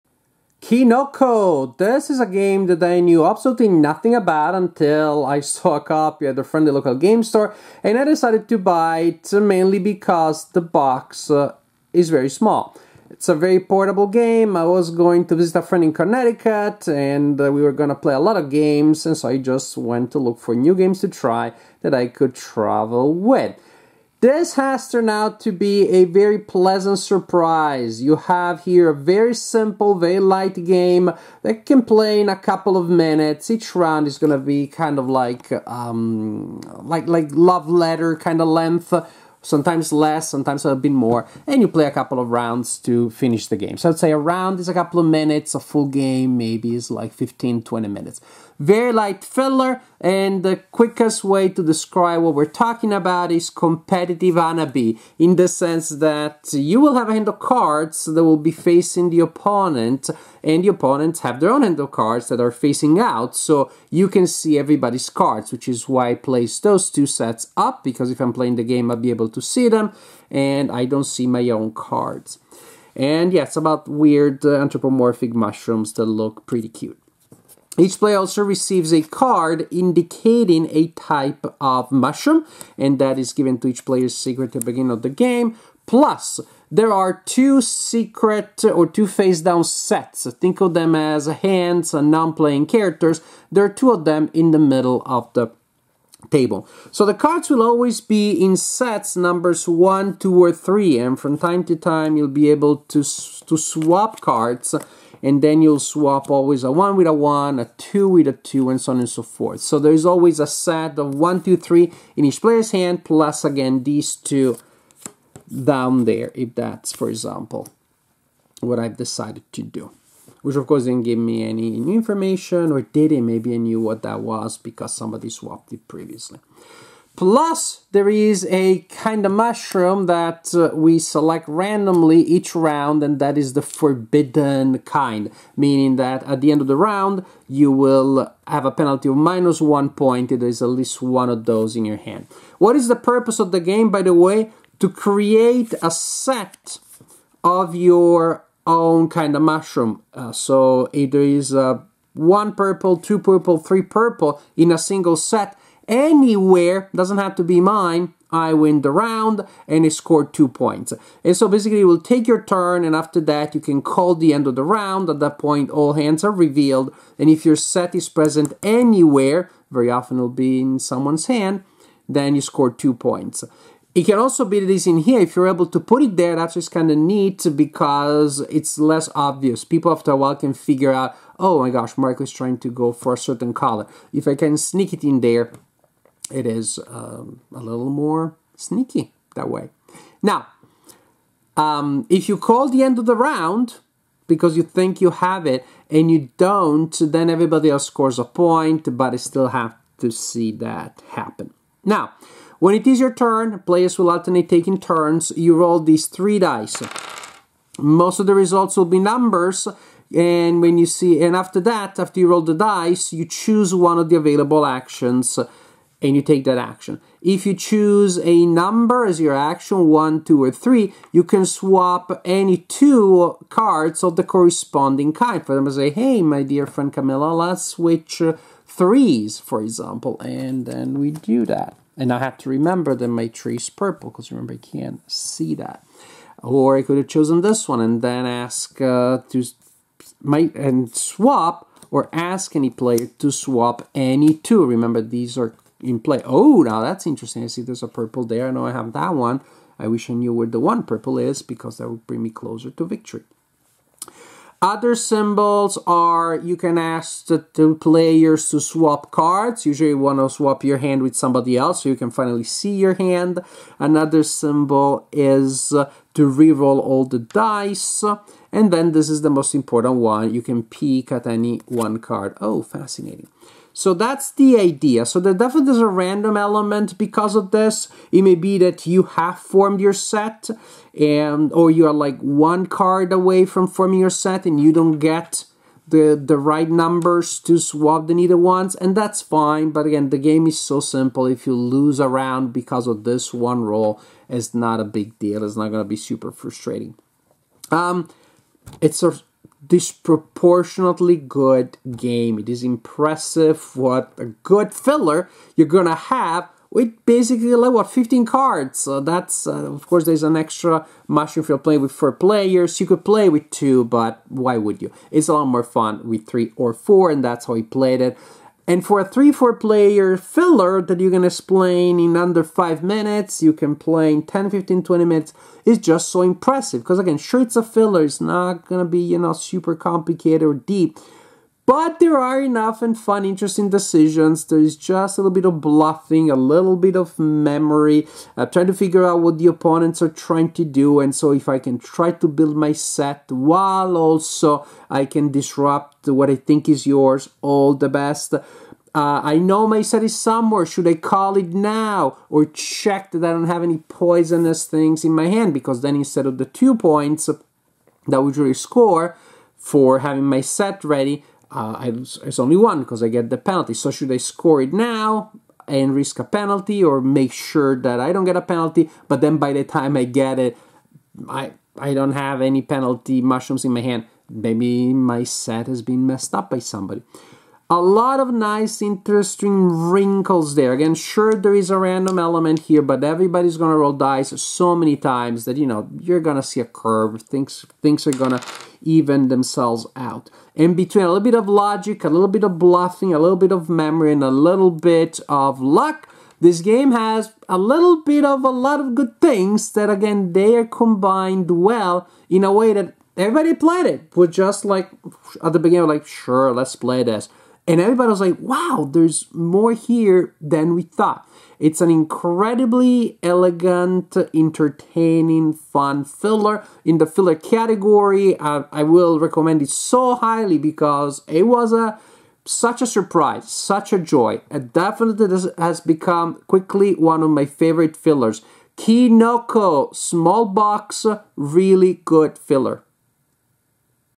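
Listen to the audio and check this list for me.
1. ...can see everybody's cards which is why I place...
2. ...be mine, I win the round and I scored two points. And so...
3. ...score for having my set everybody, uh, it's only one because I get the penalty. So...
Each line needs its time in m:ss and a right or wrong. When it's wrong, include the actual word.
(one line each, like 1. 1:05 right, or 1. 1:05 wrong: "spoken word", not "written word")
1. 1:04 right
2. 2:37 right
3. 5:58 wrong: "ready", not "everybody".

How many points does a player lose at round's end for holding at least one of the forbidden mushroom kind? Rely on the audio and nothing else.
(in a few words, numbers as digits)
1.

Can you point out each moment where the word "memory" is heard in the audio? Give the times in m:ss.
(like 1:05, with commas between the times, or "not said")
5:37, 6:33.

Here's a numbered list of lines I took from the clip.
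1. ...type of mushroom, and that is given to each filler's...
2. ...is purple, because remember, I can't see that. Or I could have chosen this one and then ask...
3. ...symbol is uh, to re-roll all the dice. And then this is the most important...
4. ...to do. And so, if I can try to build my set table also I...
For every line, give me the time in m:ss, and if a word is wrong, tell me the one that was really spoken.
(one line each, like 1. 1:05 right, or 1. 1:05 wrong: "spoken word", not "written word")
1. 1:20 wrong: "player", not "filler"
2. 3:53 right
3. 4:24 right
4. 5:40 wrong: "while", not "table".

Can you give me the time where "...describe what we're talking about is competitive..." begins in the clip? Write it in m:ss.
0:51.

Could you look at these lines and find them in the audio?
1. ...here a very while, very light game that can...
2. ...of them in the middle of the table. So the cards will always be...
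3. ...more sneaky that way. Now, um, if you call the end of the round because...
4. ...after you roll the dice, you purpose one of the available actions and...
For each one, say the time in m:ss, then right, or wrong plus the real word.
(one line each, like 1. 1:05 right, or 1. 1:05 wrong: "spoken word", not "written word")
1. 0:28 wrong: "simple", not "while"
2. 1:33 right
3. 3:07 right
4. 3:31 wrong: "choose", not "purpose".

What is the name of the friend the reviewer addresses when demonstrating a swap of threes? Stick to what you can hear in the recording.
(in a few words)
Camilla.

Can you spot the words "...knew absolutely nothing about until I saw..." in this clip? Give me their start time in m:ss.
0:03.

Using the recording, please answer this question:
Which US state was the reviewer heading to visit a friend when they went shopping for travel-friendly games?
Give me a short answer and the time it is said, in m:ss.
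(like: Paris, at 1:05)
Connecticut, at 0:15.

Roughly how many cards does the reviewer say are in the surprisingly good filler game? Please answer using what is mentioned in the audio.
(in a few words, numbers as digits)
15.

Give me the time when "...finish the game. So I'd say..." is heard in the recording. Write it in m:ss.
0:43.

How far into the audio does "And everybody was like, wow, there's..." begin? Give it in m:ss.
6:47.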